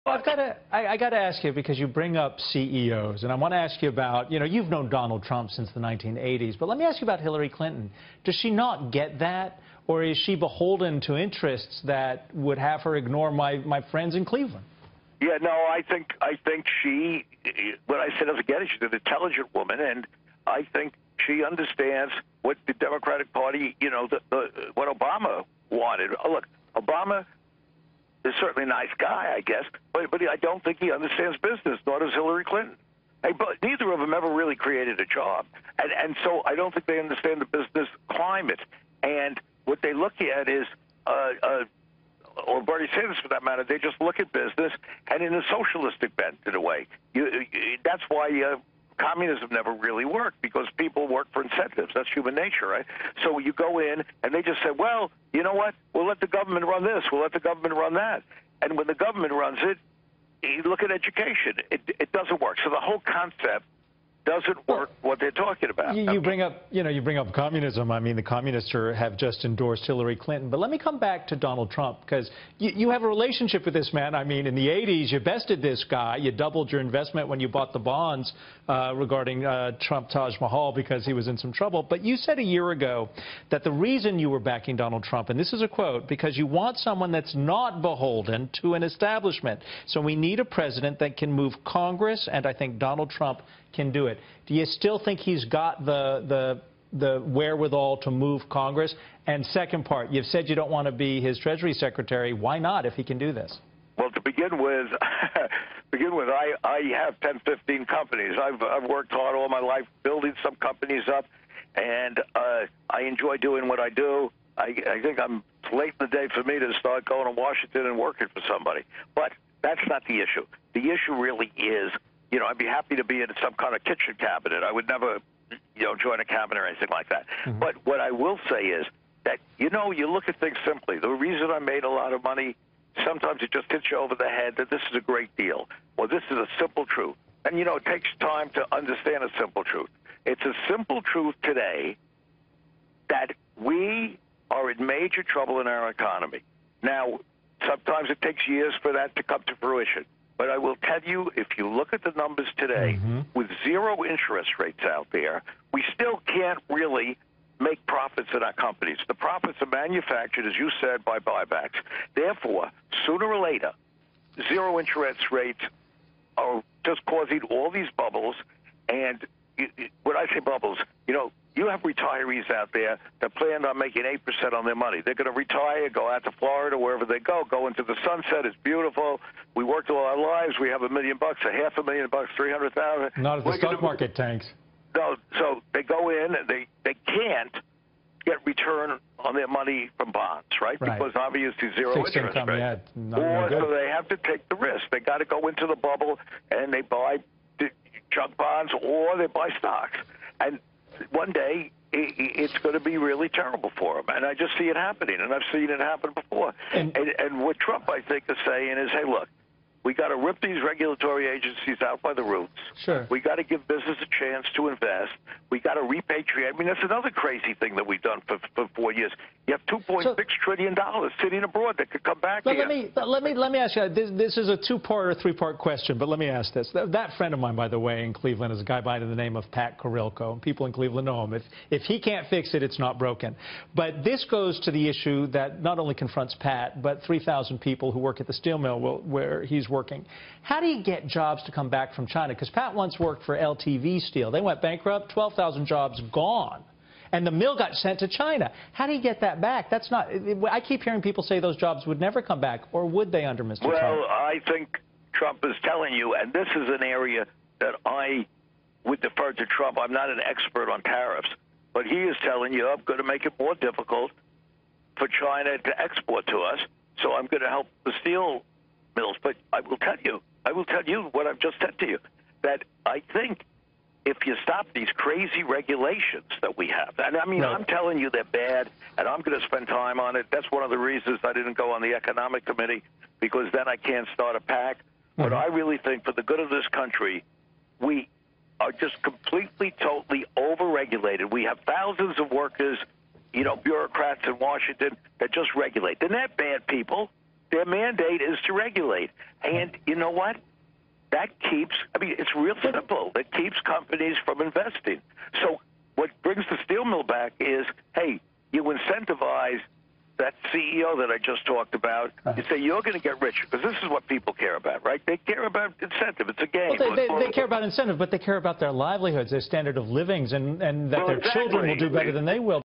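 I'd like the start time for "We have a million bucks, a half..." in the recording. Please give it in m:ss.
3:00.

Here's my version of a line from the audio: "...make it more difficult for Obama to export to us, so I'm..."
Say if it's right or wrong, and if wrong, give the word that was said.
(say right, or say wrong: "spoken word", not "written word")
wrong: "China", not "Obama".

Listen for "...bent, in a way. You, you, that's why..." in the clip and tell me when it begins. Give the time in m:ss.
0:46.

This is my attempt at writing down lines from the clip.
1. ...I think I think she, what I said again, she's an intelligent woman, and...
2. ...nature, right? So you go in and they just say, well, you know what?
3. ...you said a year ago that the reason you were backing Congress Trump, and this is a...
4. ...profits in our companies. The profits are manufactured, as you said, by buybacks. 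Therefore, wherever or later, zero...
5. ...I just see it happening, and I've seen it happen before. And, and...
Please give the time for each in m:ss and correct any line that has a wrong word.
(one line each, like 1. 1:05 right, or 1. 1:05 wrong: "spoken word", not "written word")
1. 0:15 right
2. 0:52 right
3. 1:22 wrong: "Donald", not "Congress"
4. 2:37 wrong: "sooner", not "wherever"
5. 3:24 right.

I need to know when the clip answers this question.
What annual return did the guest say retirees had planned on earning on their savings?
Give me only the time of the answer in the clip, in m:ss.
2:54.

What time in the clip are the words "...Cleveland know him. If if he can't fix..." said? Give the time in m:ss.
3:50.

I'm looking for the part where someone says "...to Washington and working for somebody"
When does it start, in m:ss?
1:57.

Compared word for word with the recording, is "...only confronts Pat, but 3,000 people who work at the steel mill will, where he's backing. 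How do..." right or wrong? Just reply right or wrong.
wrong.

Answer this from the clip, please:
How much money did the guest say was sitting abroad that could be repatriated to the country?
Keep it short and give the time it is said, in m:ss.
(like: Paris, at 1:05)
2.6 trillion dollars, at 3:39.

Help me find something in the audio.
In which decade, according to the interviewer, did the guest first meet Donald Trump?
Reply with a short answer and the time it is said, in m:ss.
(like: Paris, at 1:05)
1980s, at 0:05.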